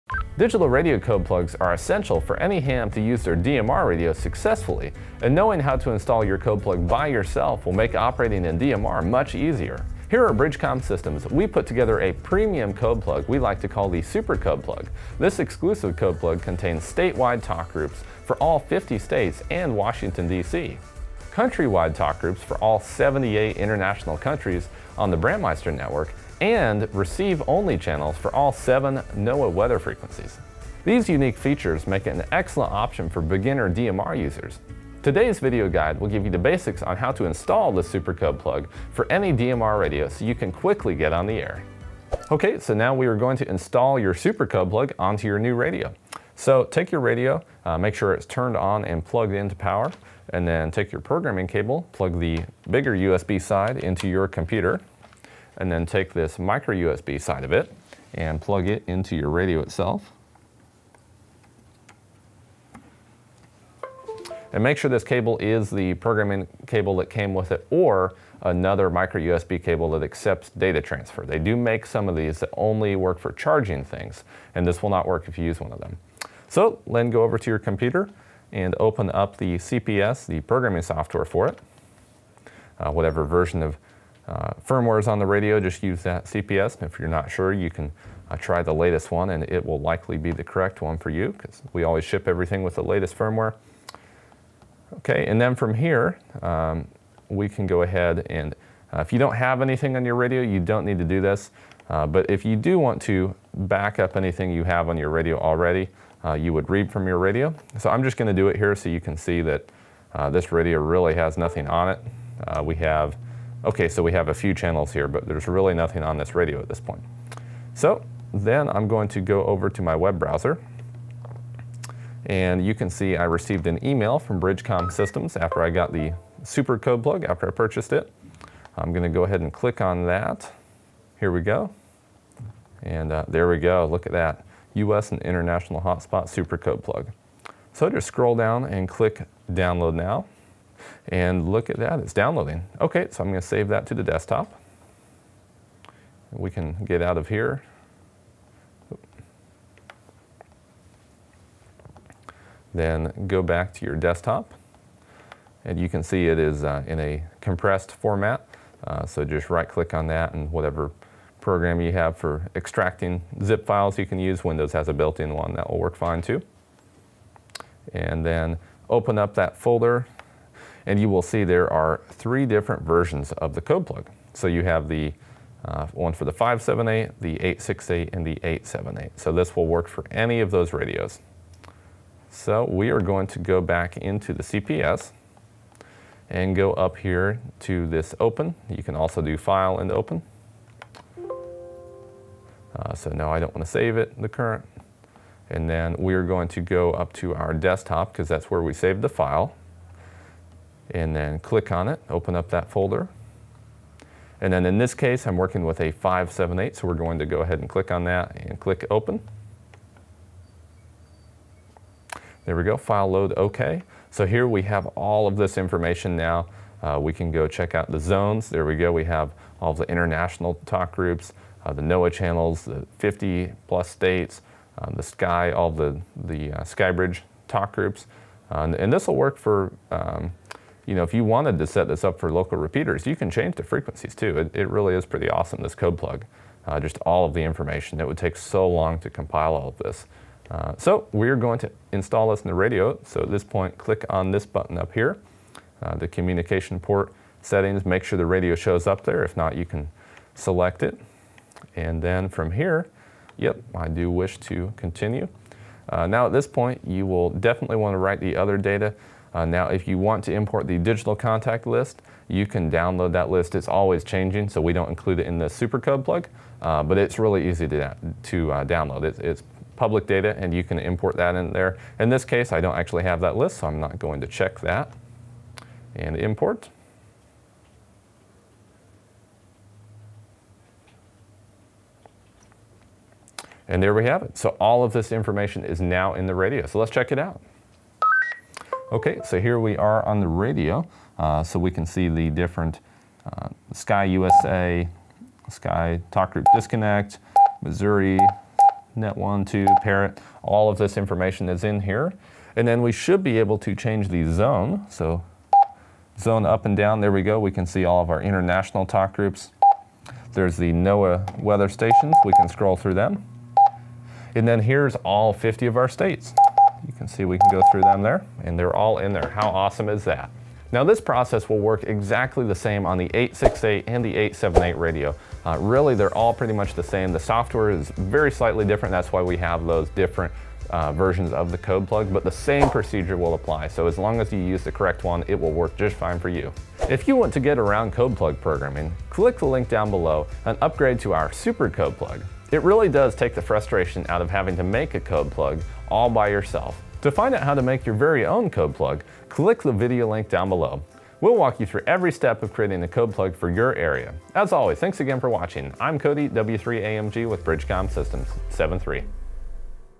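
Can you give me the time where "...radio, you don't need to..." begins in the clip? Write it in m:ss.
1:40.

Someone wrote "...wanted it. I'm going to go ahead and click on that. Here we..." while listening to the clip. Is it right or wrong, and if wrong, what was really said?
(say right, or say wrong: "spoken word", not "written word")
wrong: "purchased", not "wanted".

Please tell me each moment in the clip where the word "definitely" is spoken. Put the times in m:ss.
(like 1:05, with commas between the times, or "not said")
4:17.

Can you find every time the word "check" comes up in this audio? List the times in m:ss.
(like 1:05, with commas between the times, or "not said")
3:37, 4:34, 4:46.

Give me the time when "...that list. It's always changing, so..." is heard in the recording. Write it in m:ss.
4:23.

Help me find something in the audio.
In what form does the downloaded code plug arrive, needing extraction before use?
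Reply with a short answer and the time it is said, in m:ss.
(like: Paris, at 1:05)
compressed format, at 2:37.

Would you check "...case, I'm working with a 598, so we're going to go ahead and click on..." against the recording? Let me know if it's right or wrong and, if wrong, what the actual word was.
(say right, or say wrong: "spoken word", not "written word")
wrong: "578", not "598".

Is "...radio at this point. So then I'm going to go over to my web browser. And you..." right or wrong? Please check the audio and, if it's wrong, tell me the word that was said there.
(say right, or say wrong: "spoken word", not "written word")
right.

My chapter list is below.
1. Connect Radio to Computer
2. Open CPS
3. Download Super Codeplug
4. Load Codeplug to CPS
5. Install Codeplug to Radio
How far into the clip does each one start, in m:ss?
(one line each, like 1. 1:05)
1. 0:42
2. 1:15
3. 1:57
4. 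3:04
5. 4:00.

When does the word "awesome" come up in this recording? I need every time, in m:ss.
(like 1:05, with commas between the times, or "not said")
3:55, 5:19.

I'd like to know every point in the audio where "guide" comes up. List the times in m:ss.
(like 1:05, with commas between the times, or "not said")
0:35.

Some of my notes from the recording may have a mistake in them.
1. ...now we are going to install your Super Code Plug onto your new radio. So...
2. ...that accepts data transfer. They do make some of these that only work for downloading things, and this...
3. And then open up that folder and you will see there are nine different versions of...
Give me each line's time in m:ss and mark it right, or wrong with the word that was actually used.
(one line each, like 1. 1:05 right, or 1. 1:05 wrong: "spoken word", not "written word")
1. 0:42 right
2. 1:09 wrong: "charging", not "downloading"
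3. 2:47 wrong: "three", not "nine".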